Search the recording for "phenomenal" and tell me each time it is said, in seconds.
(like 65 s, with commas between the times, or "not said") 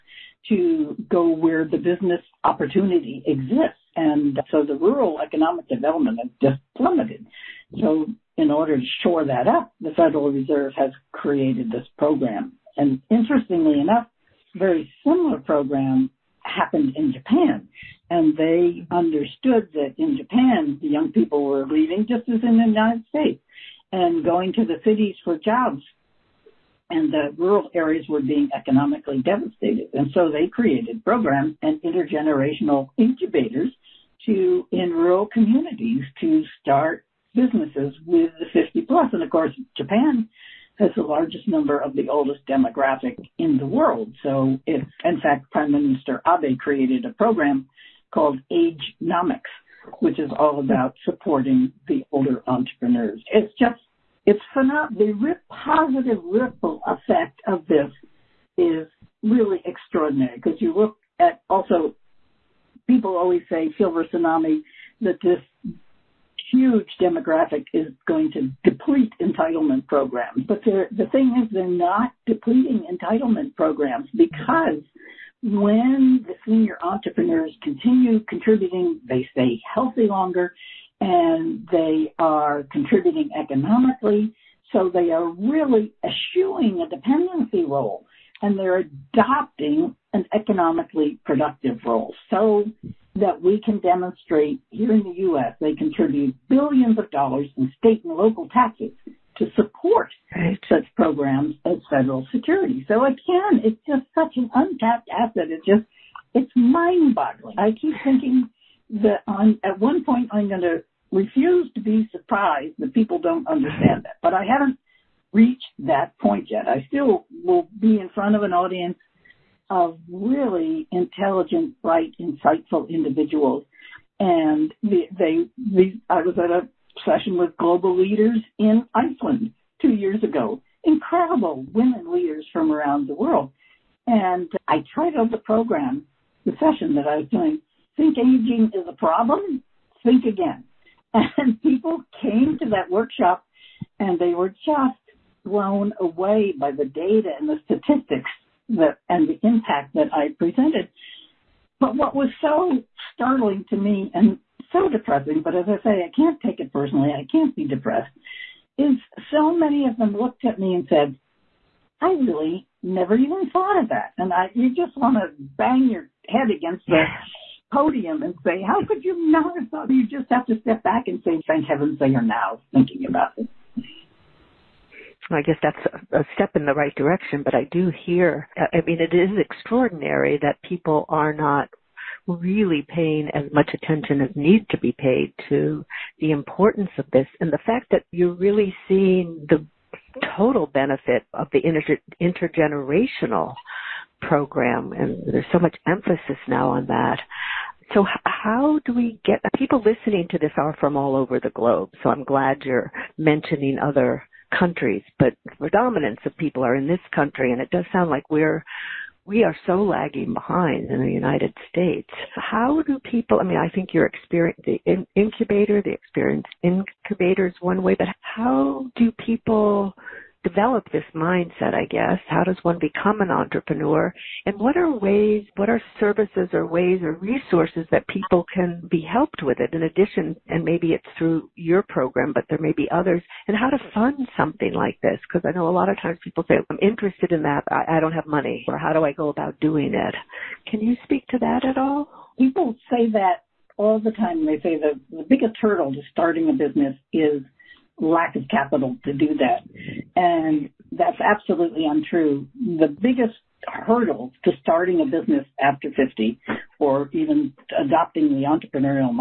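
54 s.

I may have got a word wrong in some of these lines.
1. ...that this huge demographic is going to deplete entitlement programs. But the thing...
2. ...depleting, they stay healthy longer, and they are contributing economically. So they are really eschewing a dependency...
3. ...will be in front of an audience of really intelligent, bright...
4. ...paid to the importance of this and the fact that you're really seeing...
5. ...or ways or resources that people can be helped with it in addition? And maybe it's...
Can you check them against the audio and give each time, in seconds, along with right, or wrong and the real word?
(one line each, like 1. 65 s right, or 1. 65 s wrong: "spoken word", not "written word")
1. 65 s right
2. 78 s wrong: "contributing", not "depleting"
3. 117 s right
4. 184 s right
5. 226 s right.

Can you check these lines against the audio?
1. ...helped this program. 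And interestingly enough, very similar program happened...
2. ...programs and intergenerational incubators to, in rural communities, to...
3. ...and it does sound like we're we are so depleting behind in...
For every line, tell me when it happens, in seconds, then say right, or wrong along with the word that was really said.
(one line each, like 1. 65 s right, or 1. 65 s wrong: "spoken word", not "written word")
1. 11 s wrong: "created", not "helped"
2. 31 s right
3. 207 s wrong: "lagging", not "depleting".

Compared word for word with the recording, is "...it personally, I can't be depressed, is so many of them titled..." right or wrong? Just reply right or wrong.
wrong.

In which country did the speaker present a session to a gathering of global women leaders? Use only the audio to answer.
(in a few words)
Iceland.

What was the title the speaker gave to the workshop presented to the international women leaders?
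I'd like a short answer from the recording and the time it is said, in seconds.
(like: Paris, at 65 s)
Think Aging is a Problem? Think Again, at 137 s.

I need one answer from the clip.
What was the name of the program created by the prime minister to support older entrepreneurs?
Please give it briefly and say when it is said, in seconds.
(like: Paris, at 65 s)
Nomics, at 49 s.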